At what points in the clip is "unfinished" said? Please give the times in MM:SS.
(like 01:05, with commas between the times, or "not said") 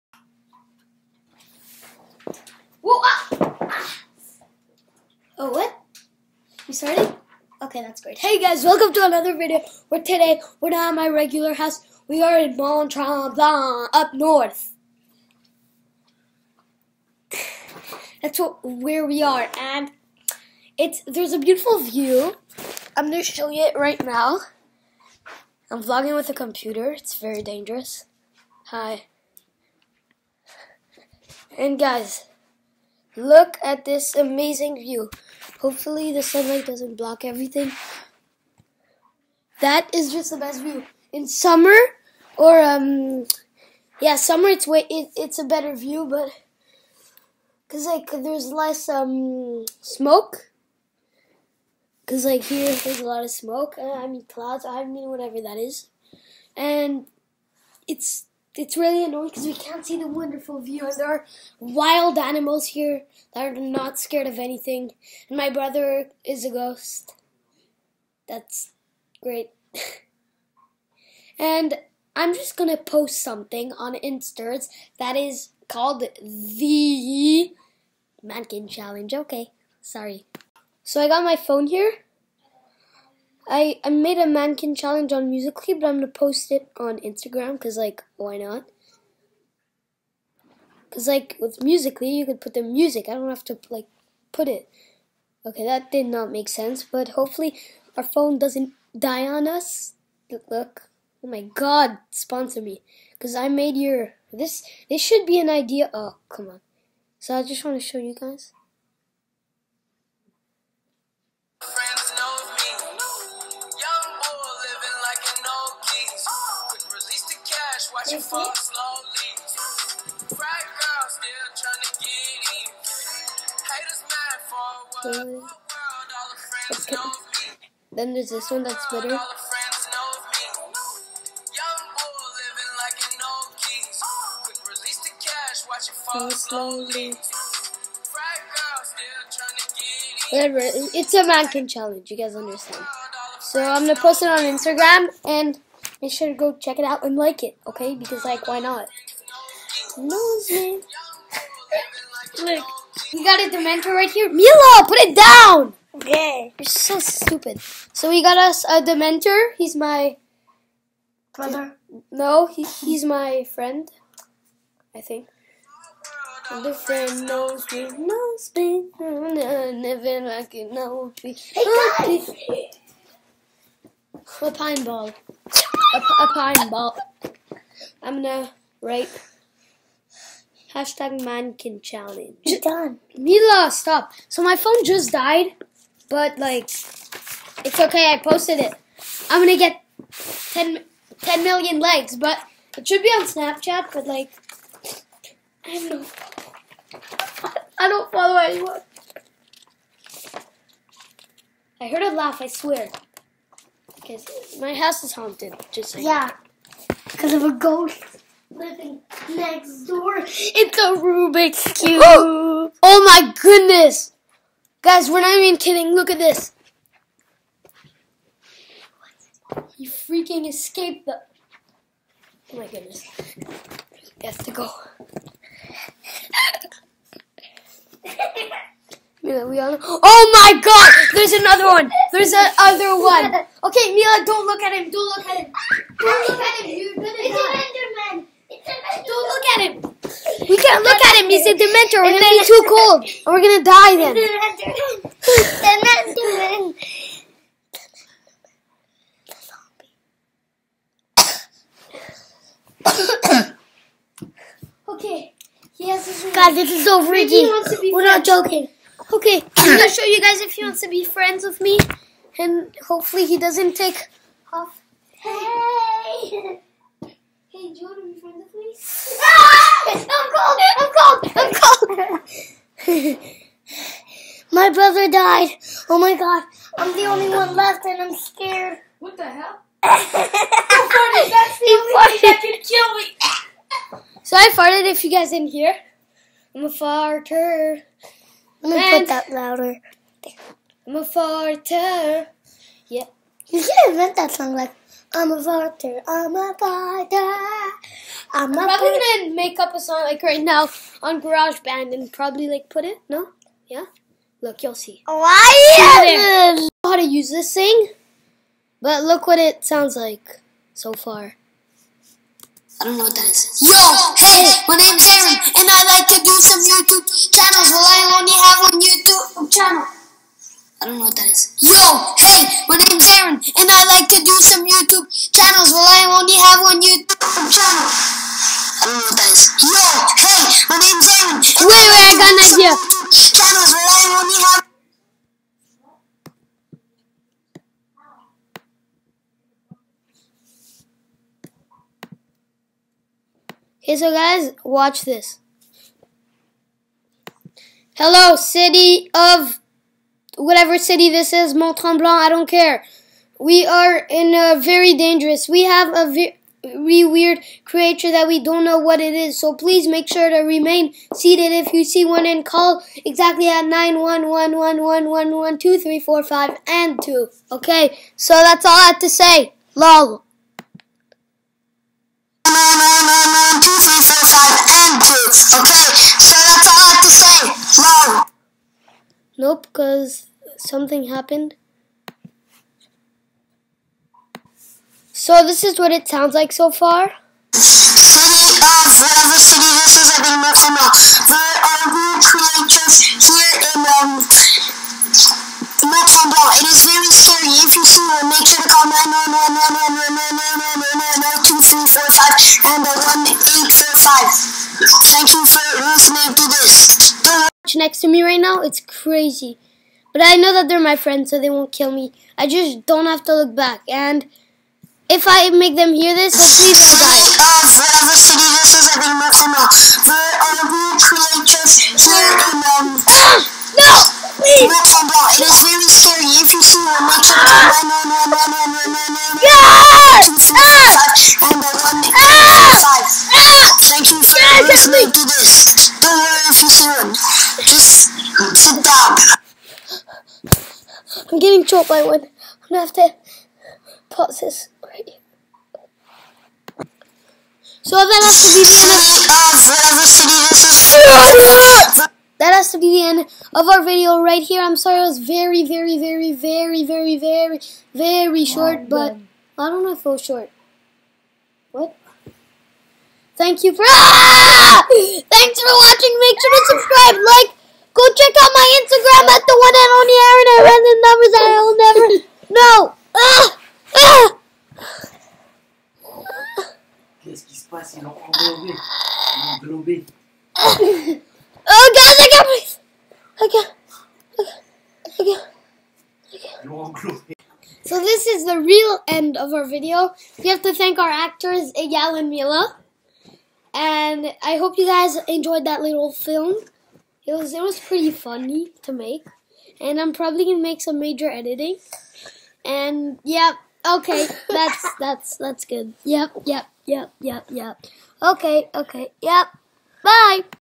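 not said.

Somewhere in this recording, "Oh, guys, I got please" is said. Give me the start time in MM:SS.
08:01.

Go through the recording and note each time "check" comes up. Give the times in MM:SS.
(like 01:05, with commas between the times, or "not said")
02:26, 07:48.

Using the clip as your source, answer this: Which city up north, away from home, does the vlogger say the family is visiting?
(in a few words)
Montreal.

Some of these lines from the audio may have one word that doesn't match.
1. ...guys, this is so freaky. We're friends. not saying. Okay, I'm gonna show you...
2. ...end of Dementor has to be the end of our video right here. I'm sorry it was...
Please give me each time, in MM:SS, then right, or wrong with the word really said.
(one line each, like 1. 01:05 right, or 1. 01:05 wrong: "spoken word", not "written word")
1. 04:16 wrong: "joking", not "saying"
2. 07:31 wrong: "That", not "Dementor".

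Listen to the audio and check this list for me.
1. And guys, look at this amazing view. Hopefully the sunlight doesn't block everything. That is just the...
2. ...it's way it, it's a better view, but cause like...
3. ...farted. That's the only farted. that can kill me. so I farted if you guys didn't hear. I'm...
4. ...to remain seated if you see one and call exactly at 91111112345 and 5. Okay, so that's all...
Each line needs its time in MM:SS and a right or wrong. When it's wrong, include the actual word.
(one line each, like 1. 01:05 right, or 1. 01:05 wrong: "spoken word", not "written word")
1. 00:31 right
2. 00:44 right
3. 04:39 right
4. 06:00 wrong: "2", not "5".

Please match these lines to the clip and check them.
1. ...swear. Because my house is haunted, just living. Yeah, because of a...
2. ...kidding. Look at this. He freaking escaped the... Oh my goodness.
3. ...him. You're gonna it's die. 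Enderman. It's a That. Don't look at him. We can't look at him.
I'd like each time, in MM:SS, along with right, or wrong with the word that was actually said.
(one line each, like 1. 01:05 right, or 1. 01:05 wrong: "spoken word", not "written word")
1. 03:22 wrong: "saying", not "living"
2. 03:35 right
3. 03:56 wrong: "Enderman", not "That".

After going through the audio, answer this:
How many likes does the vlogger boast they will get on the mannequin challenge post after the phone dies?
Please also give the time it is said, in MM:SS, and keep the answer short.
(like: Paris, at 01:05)
10 million, at 03:11.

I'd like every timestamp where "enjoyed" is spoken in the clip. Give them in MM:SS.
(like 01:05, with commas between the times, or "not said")
08:15.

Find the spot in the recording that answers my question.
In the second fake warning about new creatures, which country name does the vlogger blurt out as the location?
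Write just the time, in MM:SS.
07:04.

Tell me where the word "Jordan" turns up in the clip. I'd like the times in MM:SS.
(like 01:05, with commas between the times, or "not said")
04:27.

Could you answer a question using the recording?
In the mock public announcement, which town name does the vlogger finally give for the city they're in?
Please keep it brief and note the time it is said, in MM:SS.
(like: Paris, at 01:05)
Mont Tremblant, at 05:51.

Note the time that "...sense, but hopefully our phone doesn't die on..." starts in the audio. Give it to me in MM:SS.
01:36.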